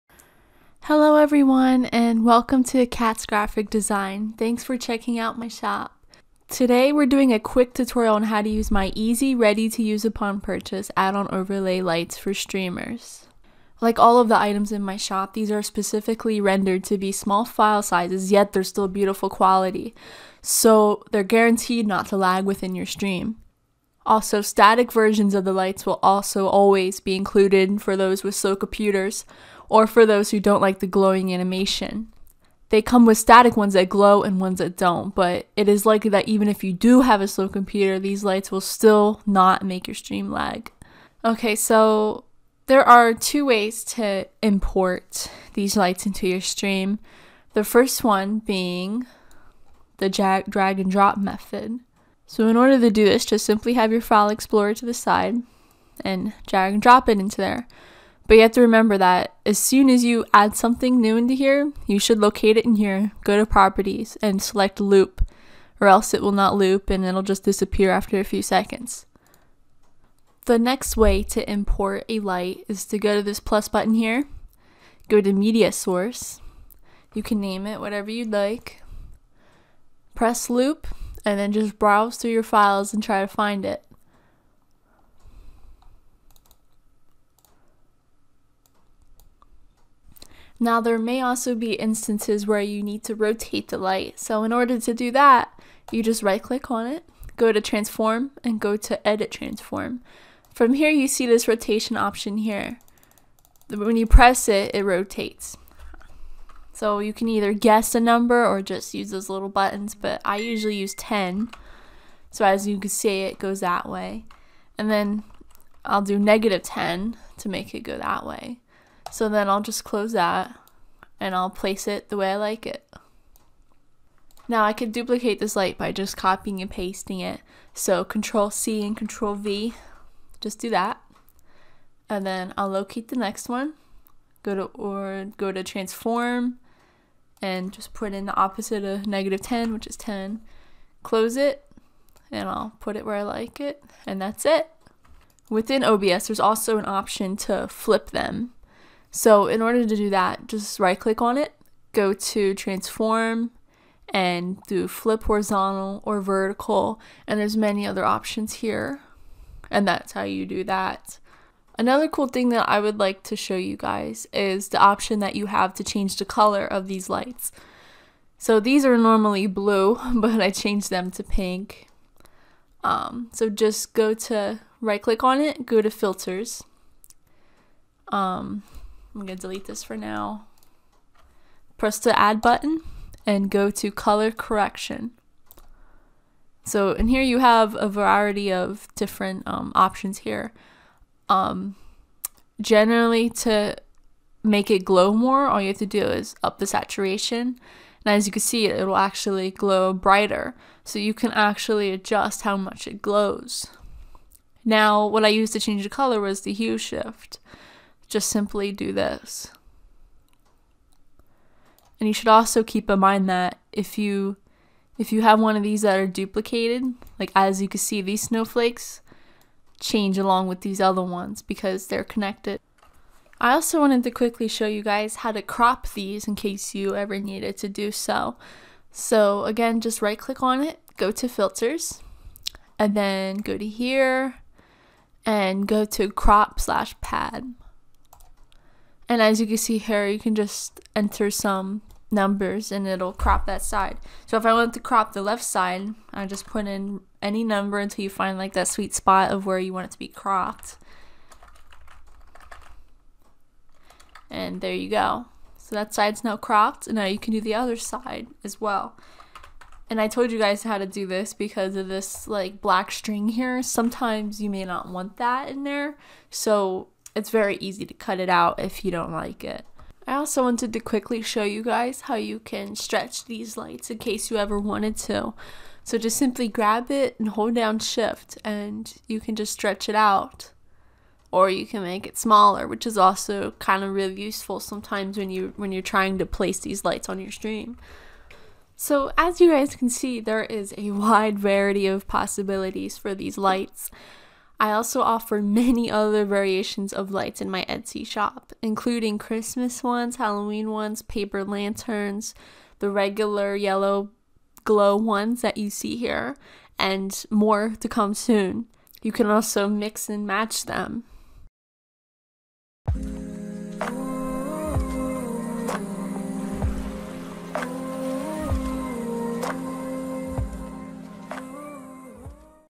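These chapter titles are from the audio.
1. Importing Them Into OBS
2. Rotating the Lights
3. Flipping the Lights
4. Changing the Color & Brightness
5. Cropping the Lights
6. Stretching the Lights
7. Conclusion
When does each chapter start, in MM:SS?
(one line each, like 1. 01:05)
1. 00:43
2. 01:30
3. 02:25
4. 02:41
5. 03:45
6. 04:30
7. 04:48.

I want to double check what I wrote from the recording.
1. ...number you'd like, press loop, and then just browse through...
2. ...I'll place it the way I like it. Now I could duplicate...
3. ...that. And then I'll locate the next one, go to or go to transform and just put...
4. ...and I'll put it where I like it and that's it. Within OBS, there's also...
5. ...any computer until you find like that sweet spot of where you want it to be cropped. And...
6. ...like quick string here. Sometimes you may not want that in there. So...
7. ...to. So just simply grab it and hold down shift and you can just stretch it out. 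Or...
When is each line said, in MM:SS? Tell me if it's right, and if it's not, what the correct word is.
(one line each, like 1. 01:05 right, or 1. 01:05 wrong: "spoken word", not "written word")
1. 01:17 wrong: "whatever", not "number"
2. 02:01 right
3. 02:10 right
4. 02:22 right
5. 04:07 wrong: "number", not "computer"
6. 04:22 wrong: "black", not "quick"
7. 04:34 right.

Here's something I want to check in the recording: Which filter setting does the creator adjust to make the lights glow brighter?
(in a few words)
Saturation.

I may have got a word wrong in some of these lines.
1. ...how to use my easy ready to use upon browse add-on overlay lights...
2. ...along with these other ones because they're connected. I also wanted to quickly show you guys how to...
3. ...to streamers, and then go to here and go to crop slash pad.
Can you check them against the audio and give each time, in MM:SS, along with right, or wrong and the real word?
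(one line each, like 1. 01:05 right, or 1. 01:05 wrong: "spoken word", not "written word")
1. 00:08 wrong: "purchase", not "browse"
2. 03:40 right
3. 03:51 wrong: "filters", not "streamers".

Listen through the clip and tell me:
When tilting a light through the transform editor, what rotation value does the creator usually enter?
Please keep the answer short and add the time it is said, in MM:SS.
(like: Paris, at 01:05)
10, at 01:50.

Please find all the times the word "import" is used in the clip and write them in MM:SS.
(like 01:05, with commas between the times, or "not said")
00:44, 01:11.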